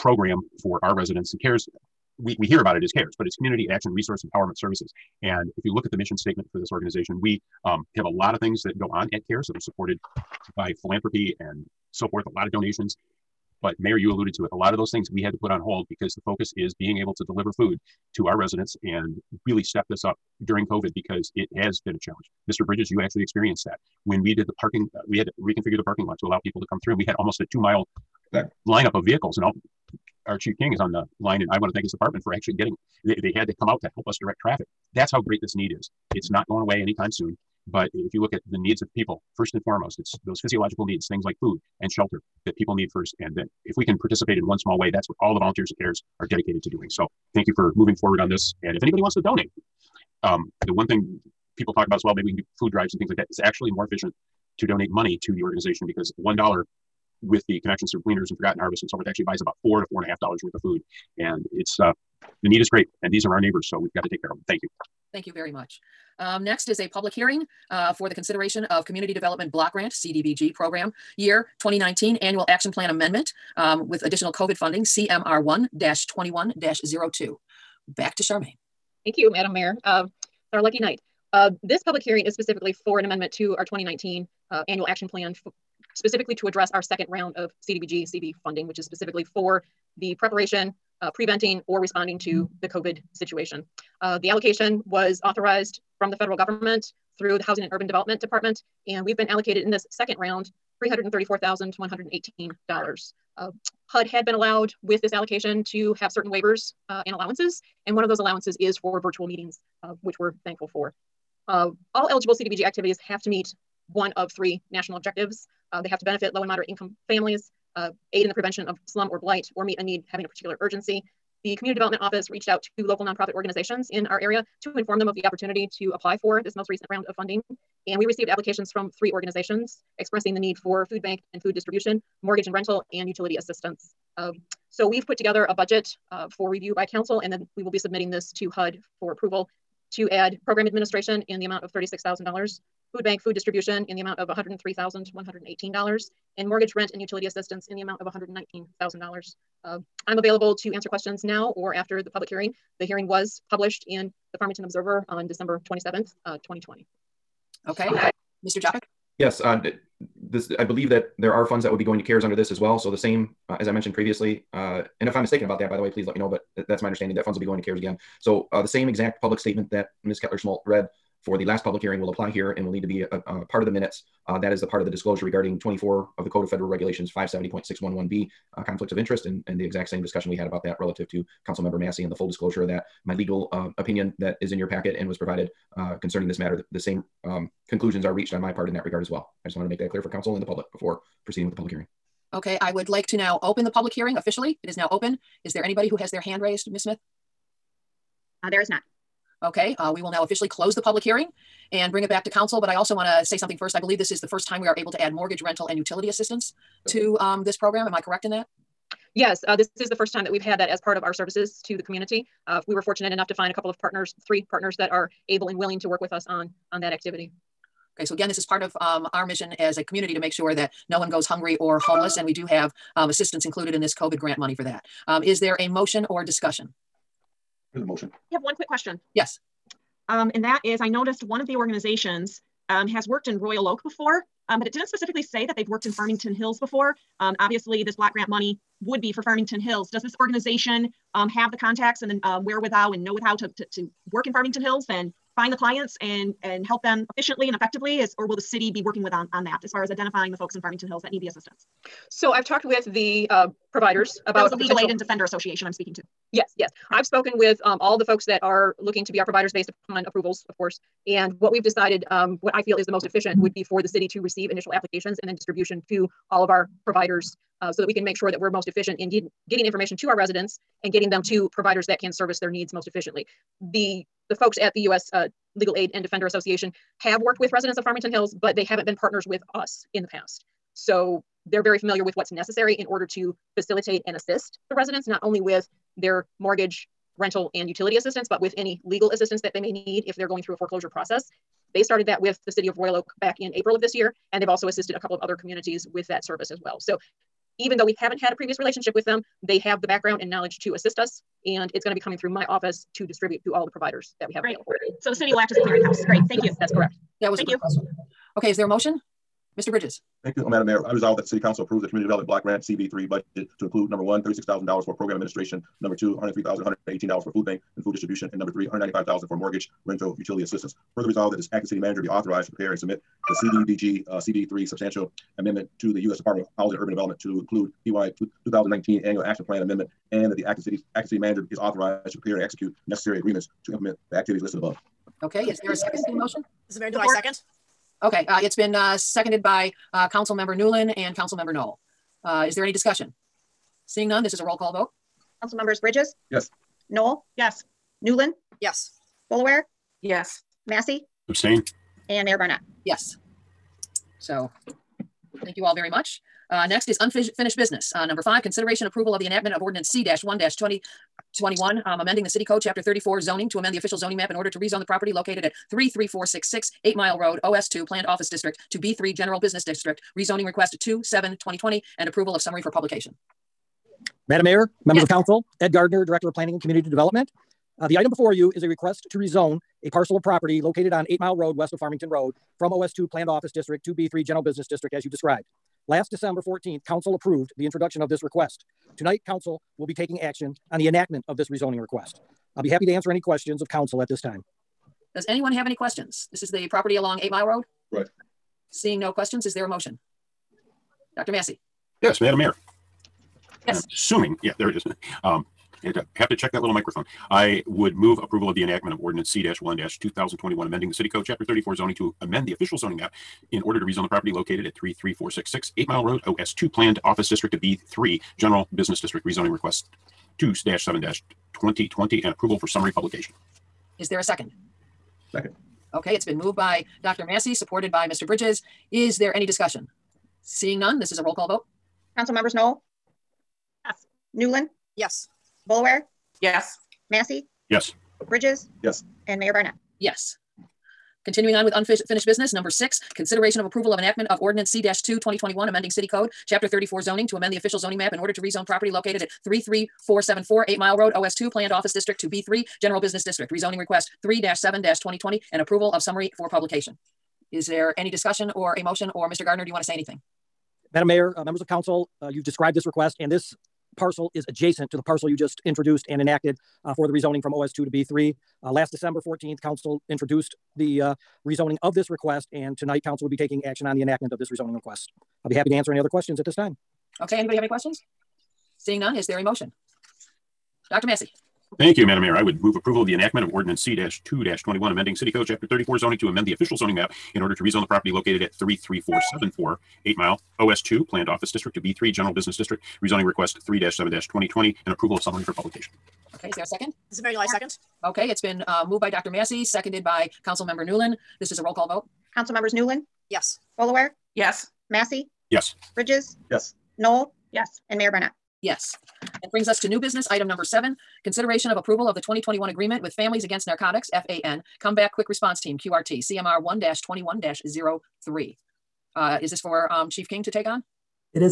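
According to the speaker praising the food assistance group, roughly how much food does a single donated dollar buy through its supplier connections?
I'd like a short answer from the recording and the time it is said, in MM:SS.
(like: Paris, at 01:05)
4 to 4.5 dollars, at 00:59.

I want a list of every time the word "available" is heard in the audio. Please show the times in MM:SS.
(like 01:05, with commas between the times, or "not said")
02:30, 05:04.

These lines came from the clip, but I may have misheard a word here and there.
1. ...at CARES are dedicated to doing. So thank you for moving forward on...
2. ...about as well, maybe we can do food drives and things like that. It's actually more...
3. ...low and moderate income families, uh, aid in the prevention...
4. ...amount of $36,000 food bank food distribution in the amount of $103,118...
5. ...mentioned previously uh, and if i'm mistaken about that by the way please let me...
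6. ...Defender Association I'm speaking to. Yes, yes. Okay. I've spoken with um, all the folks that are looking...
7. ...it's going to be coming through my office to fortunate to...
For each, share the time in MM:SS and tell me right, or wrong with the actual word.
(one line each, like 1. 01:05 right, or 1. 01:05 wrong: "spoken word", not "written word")
1. 00:45 right
2. 00:51 right
3. 01:56 right
4. 02:21 right
5. 02:43 right
6. 04:14 right
7. 05:01 wrong: "distribute", not "fortunate".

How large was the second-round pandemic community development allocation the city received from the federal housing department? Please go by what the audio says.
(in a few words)
$334,118.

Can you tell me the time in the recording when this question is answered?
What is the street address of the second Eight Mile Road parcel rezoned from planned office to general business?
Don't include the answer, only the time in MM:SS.
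07:29.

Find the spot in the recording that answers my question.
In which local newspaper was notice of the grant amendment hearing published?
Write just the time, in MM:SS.
02:34.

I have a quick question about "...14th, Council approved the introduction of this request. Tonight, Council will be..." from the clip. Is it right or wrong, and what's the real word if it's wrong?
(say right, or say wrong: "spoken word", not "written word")
right.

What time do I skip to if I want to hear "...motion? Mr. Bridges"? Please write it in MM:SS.
05:08.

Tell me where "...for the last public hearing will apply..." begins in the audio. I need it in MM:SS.
02:51.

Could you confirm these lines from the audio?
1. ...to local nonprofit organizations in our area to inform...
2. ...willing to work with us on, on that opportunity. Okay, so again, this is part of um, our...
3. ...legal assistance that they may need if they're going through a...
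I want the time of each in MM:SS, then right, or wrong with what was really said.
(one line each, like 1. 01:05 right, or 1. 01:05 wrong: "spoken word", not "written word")
1. 02:02 right
2. 03:35 wrong: "activity", not "opportunity"
3. 04:48 right.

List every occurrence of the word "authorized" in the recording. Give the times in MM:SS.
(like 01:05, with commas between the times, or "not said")
01:35, 05:22, 05:31.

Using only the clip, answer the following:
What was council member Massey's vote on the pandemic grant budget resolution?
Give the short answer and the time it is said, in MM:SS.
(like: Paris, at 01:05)
Abstain, at 05:51.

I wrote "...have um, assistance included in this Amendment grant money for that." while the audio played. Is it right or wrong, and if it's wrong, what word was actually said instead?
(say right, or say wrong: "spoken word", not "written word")
wrong: "COVID", not "Amendment".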